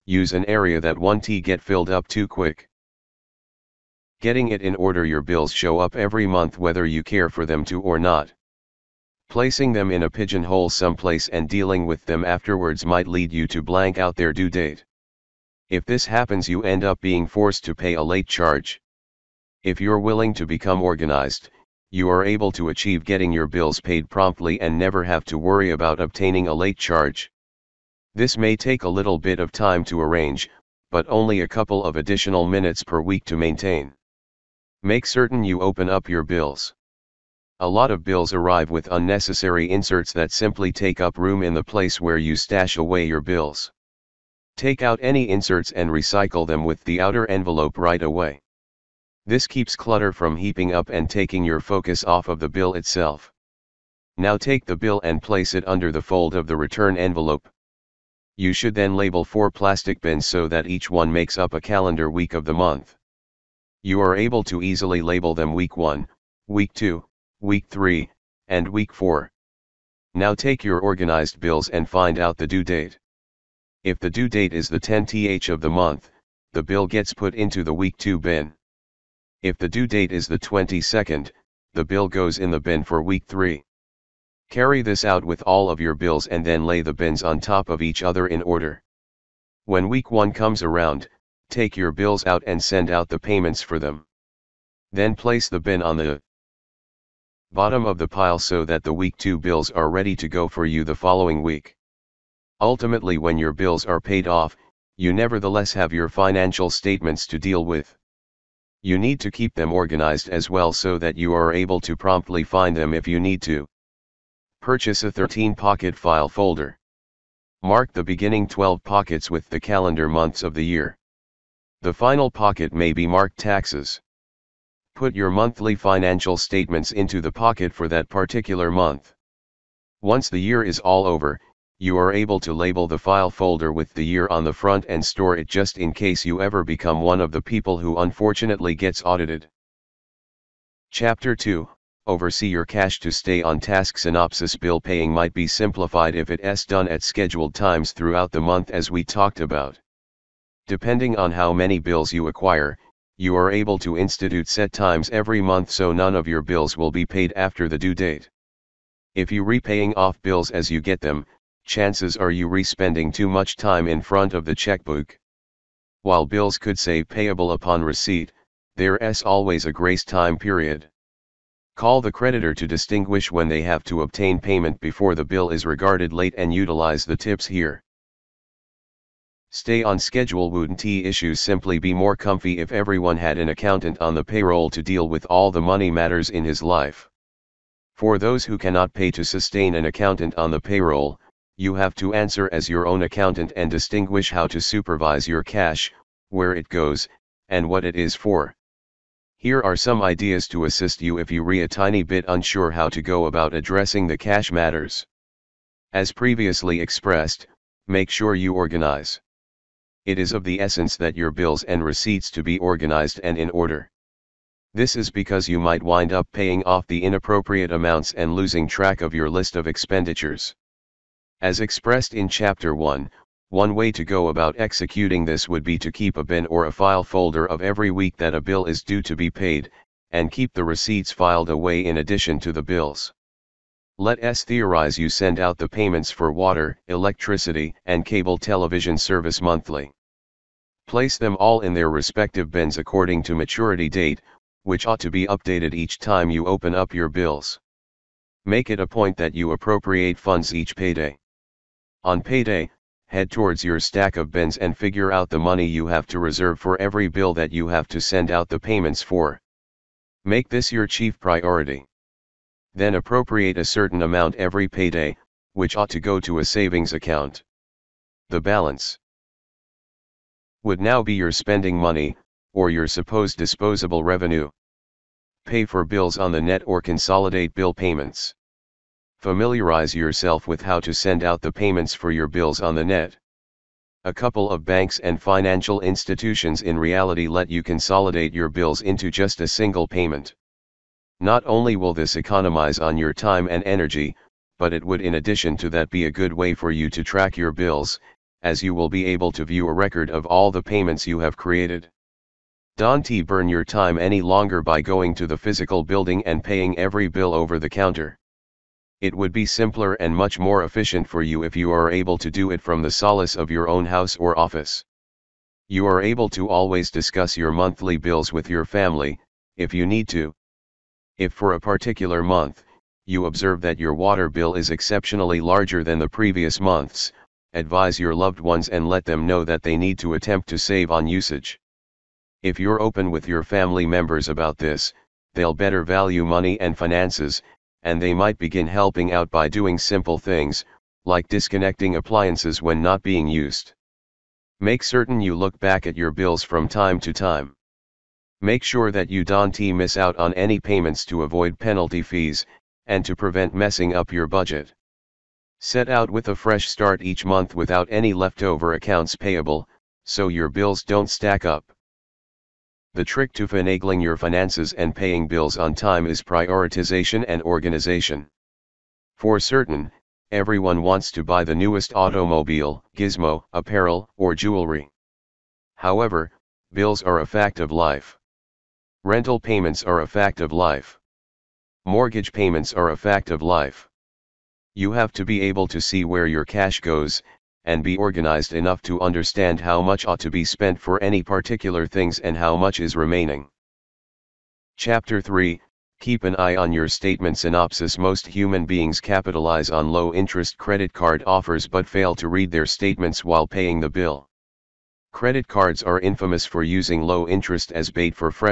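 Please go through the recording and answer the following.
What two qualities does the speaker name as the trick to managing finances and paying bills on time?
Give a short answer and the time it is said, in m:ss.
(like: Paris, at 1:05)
prioritization and organization, at 6:06.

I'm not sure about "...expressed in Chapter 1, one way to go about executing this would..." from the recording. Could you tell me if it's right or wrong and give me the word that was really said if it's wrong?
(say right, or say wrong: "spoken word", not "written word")
right.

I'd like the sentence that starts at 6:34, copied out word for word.
Chapter 3 Keep an eye on your statement synopsis.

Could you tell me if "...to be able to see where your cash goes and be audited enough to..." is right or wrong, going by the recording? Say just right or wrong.
wrong.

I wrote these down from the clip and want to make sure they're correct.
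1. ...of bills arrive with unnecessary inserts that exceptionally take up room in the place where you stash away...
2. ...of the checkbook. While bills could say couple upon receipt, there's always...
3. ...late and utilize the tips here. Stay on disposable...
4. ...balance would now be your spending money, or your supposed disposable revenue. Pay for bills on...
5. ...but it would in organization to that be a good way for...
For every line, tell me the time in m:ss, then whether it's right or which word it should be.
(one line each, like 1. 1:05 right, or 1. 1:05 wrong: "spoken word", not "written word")
1. 0:37 wrong: "simply", not "exceptionally"
2. 2:44 wrong: "payable", not "couple"
3. 2:56 wrong: "schedule", not "disposable"
4. 4:28 right
5. 4:54 wrong: "addition", not "organization".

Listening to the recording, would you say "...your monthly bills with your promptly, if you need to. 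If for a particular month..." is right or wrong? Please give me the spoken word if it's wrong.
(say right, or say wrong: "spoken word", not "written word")
wrong: "family", not "promptly".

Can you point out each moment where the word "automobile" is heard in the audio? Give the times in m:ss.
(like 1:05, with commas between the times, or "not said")
6:11.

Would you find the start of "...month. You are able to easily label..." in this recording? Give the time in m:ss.
1:02.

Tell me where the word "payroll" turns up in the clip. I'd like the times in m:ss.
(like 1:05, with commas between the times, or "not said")
3:04, 3:10.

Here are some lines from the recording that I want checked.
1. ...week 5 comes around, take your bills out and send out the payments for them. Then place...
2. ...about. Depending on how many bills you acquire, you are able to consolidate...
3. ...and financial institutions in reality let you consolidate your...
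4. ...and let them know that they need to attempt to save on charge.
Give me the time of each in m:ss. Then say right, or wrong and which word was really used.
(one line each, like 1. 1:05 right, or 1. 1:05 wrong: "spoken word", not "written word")
1. 1:29 wrong: "1", not "5"
2. 2:29 wrong: "institute", not "consolidate"
3. 4:45 right
4. 5:28 wrong: "usage", not "charge".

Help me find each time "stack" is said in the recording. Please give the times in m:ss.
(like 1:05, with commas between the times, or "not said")
4:13, 6:01.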